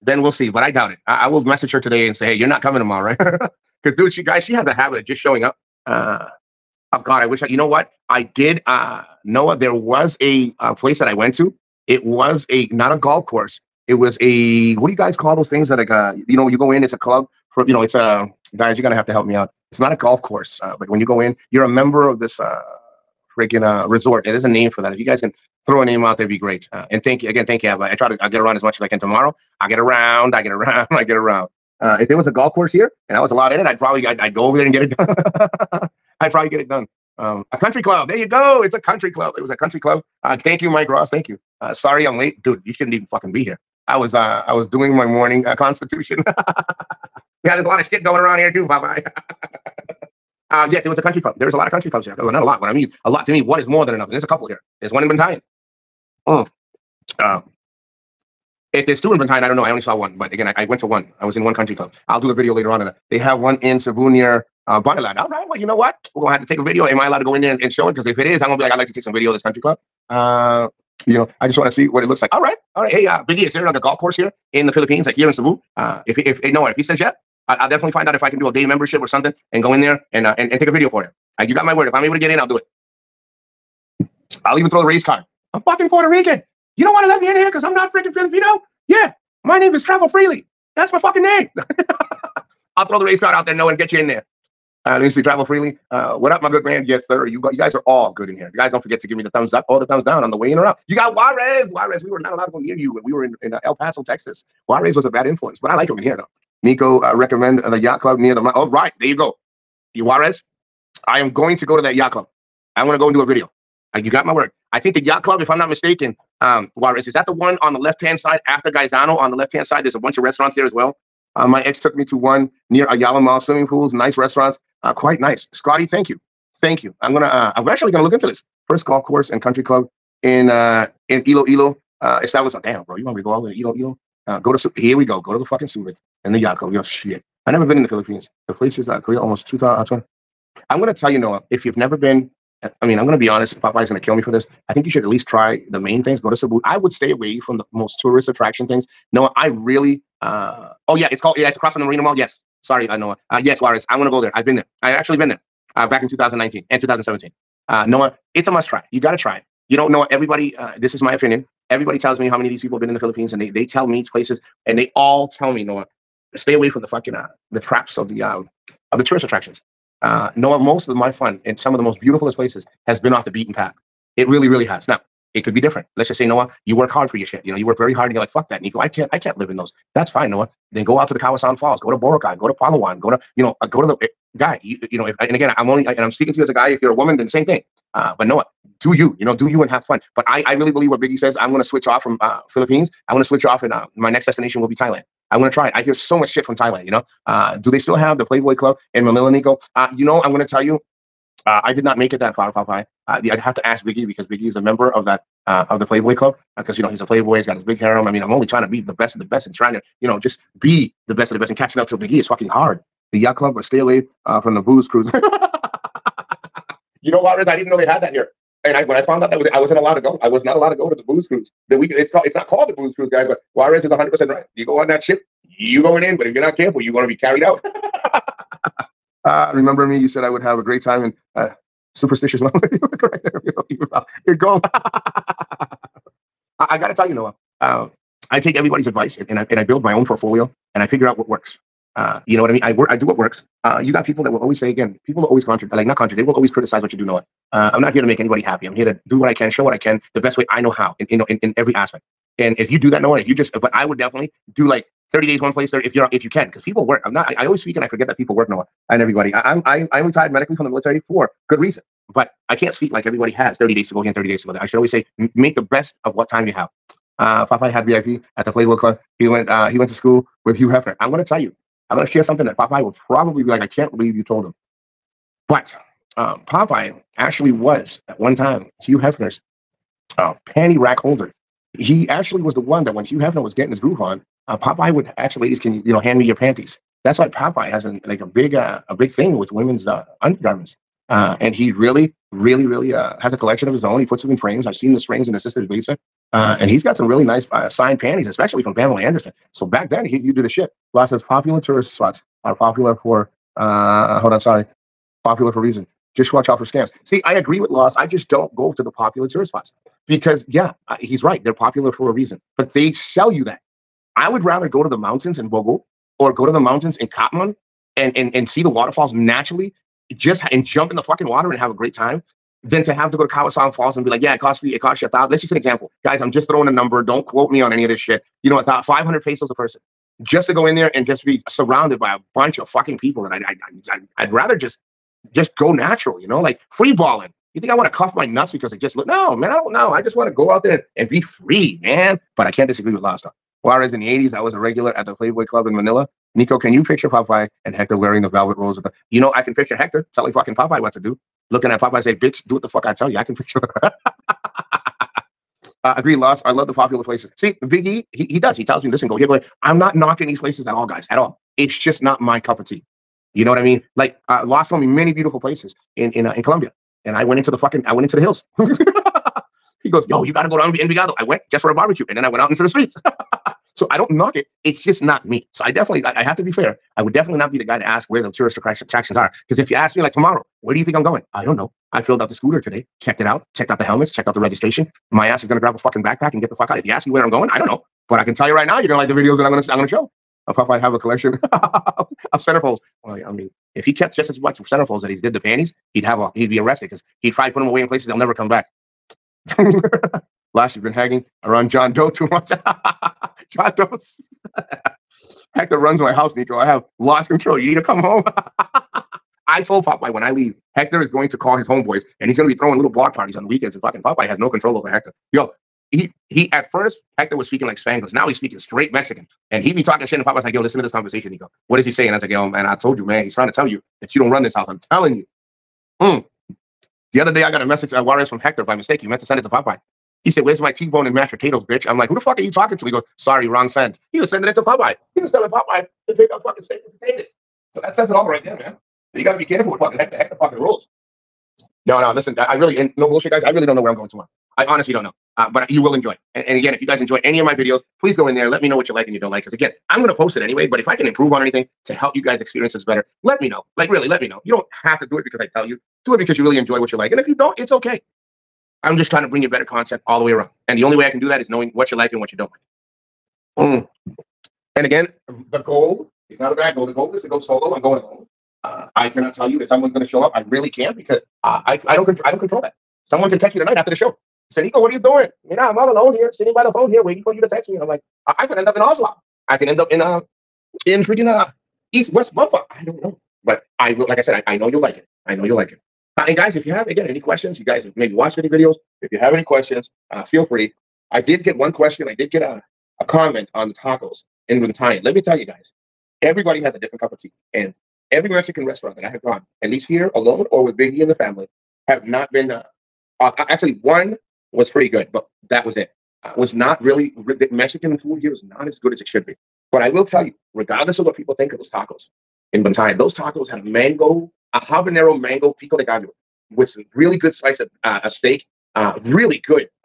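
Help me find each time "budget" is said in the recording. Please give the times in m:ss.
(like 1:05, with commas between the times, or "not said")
not said.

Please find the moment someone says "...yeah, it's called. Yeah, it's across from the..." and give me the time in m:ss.
2:30.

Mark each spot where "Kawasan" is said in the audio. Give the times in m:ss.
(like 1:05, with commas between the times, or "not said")
3:01, 5:23.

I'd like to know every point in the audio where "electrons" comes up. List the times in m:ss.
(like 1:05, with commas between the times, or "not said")
not said.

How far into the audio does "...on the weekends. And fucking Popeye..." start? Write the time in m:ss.
6:53.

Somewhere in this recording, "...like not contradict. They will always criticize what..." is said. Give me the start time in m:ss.
4:05.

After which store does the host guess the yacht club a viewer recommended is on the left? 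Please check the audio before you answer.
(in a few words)
Gaisano.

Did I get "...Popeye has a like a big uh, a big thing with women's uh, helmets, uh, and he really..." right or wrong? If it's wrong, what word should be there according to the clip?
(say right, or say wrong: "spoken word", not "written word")
wrong: "undergarments", not "helmets".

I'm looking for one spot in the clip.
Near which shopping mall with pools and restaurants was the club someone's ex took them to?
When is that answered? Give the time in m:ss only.
2:02.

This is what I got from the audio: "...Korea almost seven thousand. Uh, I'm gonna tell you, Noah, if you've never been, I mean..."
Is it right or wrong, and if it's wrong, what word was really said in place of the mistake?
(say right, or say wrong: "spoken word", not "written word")
wrong: "two", not "seven".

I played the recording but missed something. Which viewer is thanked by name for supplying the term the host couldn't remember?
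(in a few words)
Mike Ross.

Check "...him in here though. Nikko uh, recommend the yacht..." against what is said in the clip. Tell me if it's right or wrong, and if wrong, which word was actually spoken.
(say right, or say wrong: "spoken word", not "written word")
right.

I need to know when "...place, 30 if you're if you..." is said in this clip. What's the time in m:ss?
4:15.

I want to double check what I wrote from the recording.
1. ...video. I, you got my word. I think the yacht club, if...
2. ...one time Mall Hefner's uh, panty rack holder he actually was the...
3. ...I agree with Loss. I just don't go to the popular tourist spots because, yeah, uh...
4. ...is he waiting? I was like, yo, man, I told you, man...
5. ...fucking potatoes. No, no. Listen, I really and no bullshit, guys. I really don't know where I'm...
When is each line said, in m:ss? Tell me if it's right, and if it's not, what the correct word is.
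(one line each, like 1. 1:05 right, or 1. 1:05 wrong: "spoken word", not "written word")
1. 1:53 right
2. 4:38 wrong: "Hugh", not "Mall"
3. 5:07 right
4. 7:01 wrong: "saying", not "waiting"
5. 7:20 wrong: "rules", not "potatoes".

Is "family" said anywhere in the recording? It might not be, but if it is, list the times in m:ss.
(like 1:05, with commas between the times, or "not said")
8:21.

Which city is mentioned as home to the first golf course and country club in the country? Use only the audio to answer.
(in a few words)
Iloilo.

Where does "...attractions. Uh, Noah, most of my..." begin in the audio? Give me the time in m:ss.
2:49.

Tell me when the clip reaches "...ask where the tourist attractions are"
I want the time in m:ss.
6:17.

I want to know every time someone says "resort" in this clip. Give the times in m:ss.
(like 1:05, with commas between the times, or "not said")
0:23.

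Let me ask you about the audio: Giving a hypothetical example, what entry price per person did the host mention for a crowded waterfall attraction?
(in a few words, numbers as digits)
500 pesos.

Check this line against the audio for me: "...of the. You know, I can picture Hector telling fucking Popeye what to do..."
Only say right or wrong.
right.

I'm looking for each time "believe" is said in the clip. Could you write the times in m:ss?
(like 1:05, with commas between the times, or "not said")
3:10, 4:33.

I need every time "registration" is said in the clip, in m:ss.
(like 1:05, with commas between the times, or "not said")
6:24.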